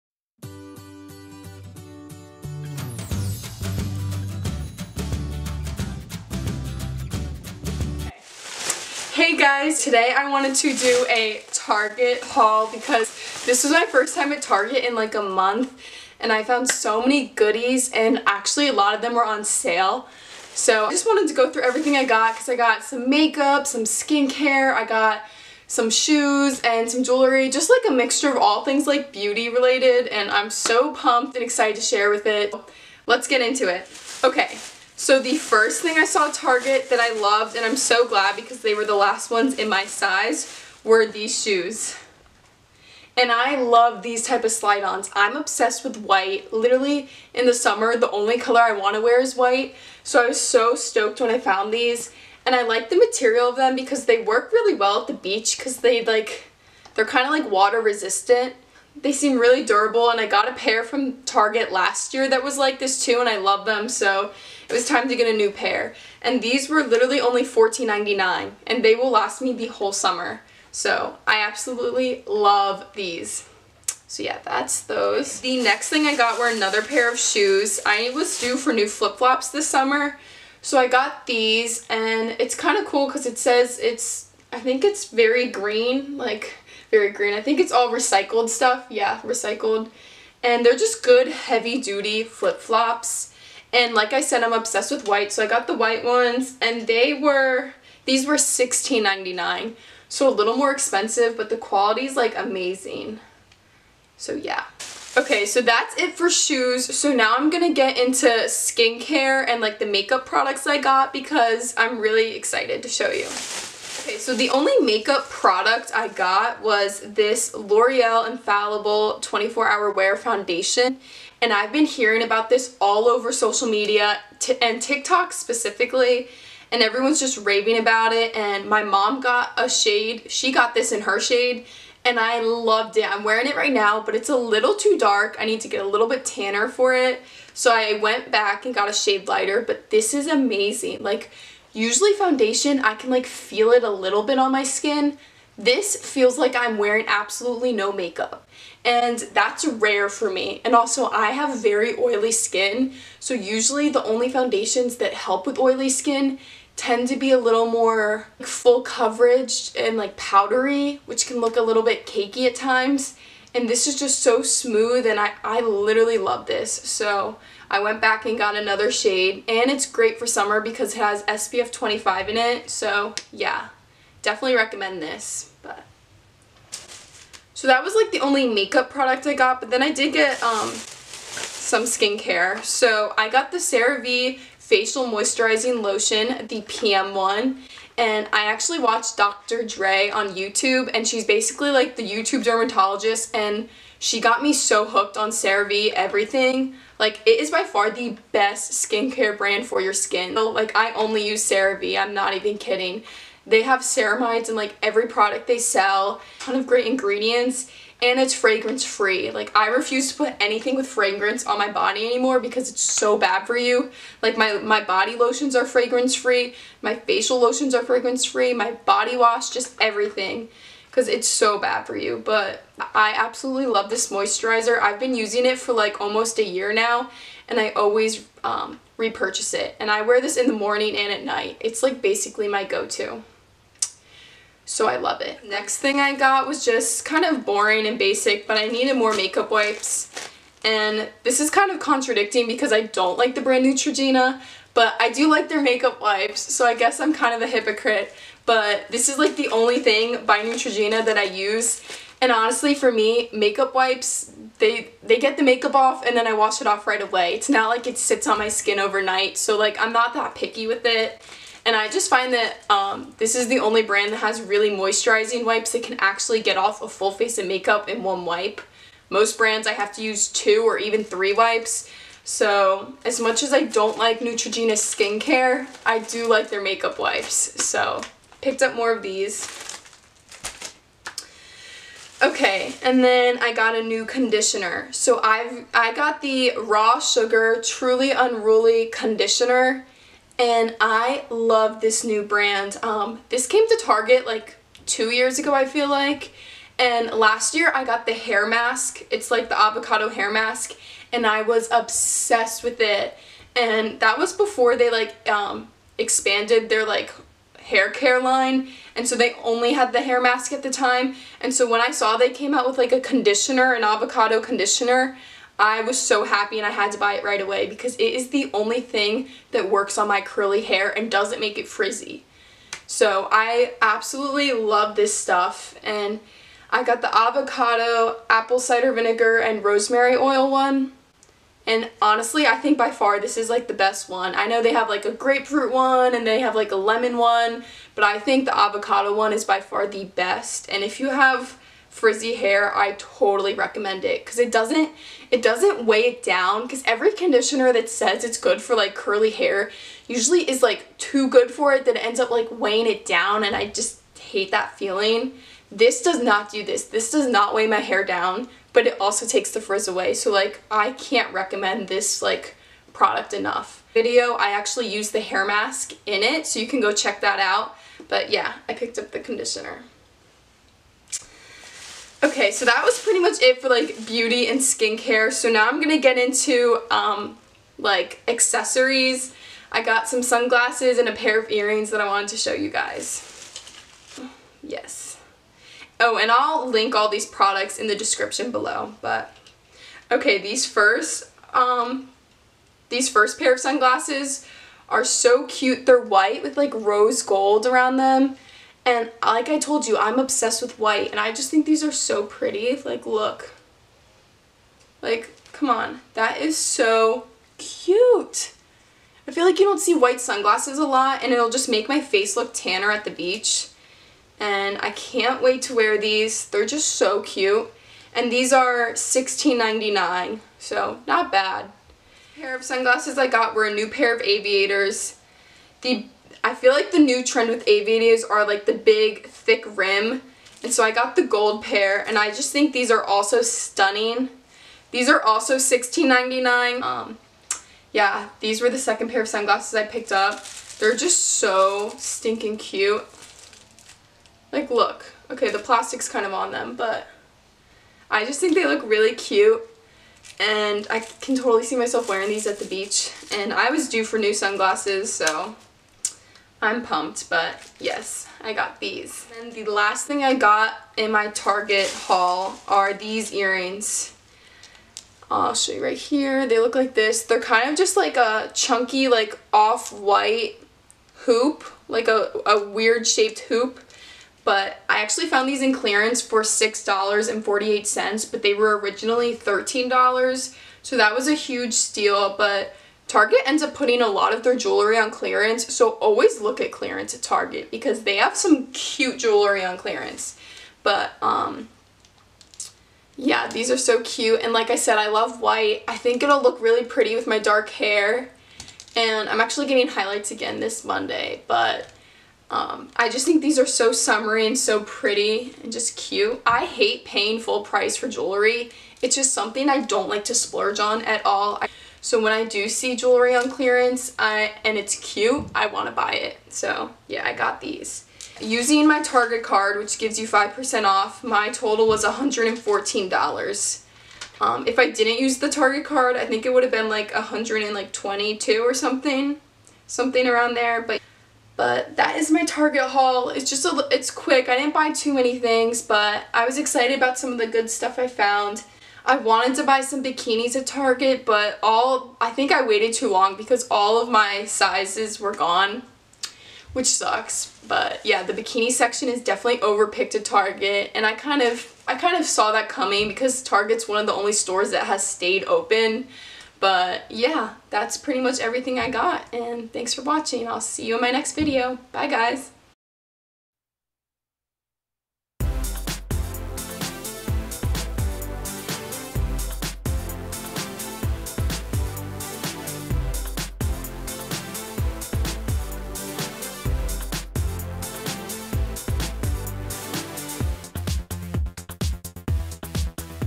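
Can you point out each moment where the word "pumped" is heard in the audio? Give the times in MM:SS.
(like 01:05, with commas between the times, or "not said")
00:30, 07:36.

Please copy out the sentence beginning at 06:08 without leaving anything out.
But yeah, I picked up the conditioner.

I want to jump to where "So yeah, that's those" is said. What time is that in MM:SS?
01:14.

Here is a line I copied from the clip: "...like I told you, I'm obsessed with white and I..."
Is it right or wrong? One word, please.
right.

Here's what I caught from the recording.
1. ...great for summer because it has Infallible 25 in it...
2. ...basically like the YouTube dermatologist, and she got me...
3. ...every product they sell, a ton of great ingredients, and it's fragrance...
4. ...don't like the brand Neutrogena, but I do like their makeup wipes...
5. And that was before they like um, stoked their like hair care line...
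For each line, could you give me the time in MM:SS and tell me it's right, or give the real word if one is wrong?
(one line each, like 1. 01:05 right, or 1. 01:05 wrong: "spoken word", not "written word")
1. 02:49 wrong: "SPF", not "Infallible"
2. 03:11 right
3. 03:24 right
4. 04:02 right
5. 05:03 wrong: "expanded", not "stoked".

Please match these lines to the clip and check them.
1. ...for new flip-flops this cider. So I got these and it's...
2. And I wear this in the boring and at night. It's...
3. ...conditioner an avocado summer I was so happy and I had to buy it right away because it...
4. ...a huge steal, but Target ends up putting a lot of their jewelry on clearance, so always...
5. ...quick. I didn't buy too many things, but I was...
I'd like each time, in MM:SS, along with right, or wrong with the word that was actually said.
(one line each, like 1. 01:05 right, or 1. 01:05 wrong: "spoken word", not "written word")
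1. 01:18 wrong: "summer", not "cider"
2. 03:49 wrong: "morning", not "boring"
3. 05:12 wrong: "conditioner", not "summer"
4. 08:01 right
5. 08:54 right.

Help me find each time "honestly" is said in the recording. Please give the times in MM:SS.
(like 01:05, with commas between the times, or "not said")
04:12, 05:32.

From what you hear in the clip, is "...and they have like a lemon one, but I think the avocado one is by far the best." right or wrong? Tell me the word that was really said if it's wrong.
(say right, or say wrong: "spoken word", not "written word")
right.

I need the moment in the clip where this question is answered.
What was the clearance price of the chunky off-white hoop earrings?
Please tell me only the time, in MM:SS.
07:56.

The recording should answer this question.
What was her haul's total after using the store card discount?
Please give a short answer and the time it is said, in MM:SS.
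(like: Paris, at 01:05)
$114, at 08:42.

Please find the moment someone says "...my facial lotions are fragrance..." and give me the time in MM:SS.
03:36.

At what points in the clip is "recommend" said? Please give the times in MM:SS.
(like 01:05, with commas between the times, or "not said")
02:54, 05:43, 06:01.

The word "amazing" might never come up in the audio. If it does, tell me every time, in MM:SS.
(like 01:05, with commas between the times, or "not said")
01:42, 02:20.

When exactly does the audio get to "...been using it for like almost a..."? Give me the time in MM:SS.
03:44.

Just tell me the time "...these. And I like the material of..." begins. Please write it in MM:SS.
00:51.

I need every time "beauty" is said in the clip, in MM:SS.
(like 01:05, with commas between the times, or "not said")
00:29, 06:14.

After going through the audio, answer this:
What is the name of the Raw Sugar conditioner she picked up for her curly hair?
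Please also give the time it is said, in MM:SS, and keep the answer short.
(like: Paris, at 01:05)
Truly Unruly, at 04:47.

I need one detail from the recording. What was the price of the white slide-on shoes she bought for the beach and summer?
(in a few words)
$14.99.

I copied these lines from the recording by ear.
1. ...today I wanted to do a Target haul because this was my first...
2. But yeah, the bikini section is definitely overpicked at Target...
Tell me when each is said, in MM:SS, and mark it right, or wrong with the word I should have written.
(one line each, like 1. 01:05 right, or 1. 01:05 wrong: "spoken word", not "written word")
1. 00:09 right
2. 09:07 right.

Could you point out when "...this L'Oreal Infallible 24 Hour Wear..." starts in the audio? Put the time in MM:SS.
01:57.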